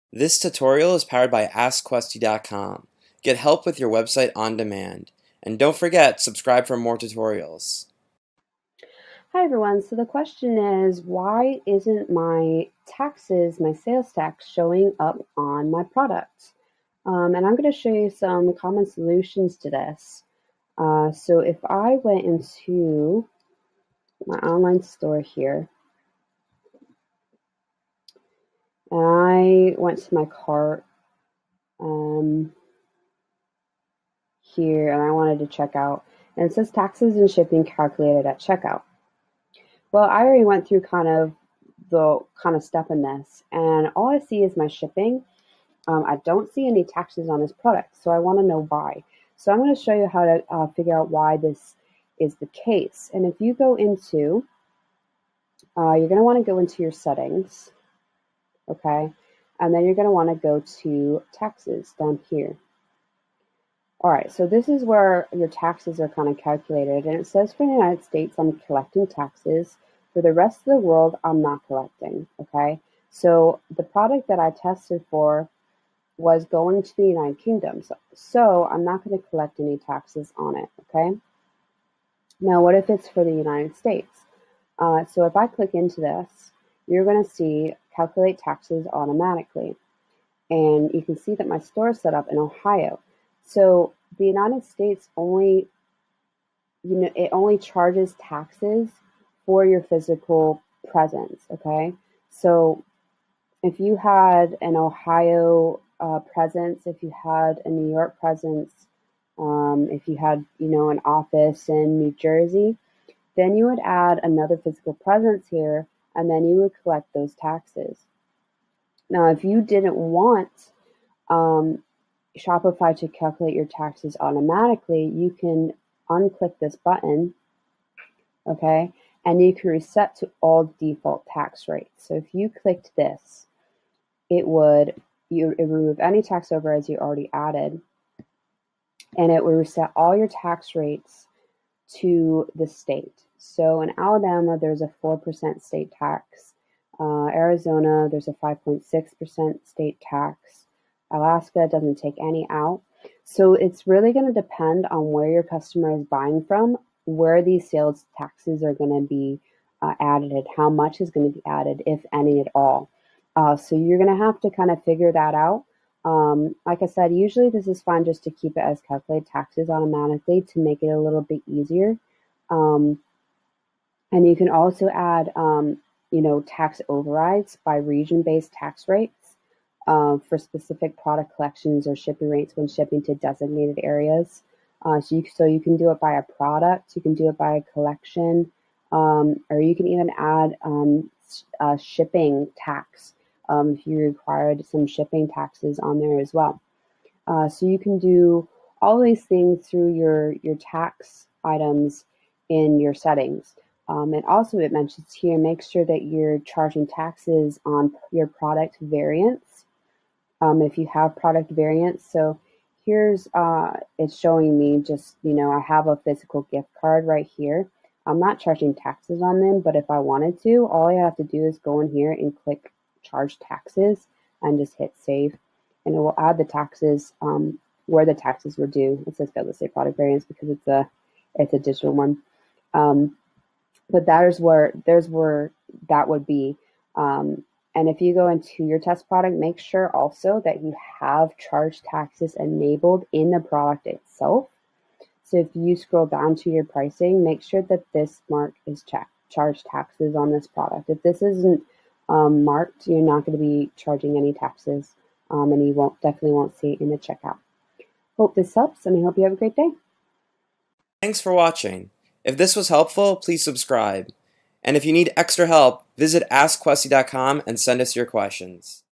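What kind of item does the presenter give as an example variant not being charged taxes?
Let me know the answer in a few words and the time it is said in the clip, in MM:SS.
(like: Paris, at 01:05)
Physical gift card, at 03:35.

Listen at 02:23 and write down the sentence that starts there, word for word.
So in Alabama, there's a 4% state tax.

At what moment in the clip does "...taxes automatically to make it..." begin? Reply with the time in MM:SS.
02:49.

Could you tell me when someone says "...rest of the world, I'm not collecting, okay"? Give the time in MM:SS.
01:10.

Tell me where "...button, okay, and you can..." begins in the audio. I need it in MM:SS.
02:06.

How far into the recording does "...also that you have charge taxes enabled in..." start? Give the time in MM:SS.
03:59.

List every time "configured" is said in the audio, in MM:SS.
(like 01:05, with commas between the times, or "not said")
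not said.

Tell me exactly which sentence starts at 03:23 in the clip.
Um, and also it mentions here, make sure that you're charging taxes on your product variants.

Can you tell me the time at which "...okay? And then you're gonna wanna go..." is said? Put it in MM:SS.
00:58.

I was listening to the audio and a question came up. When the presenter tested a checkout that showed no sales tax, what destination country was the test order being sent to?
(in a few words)
United Kingdom.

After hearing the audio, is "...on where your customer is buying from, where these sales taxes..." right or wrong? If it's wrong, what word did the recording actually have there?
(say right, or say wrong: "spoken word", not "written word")
right.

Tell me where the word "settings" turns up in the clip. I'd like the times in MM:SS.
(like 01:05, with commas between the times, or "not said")
00:56, 03:22.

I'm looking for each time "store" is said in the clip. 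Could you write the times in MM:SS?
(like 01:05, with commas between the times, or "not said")
00:24, 01:31.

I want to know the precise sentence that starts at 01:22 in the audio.
Now, what if it's for the United States?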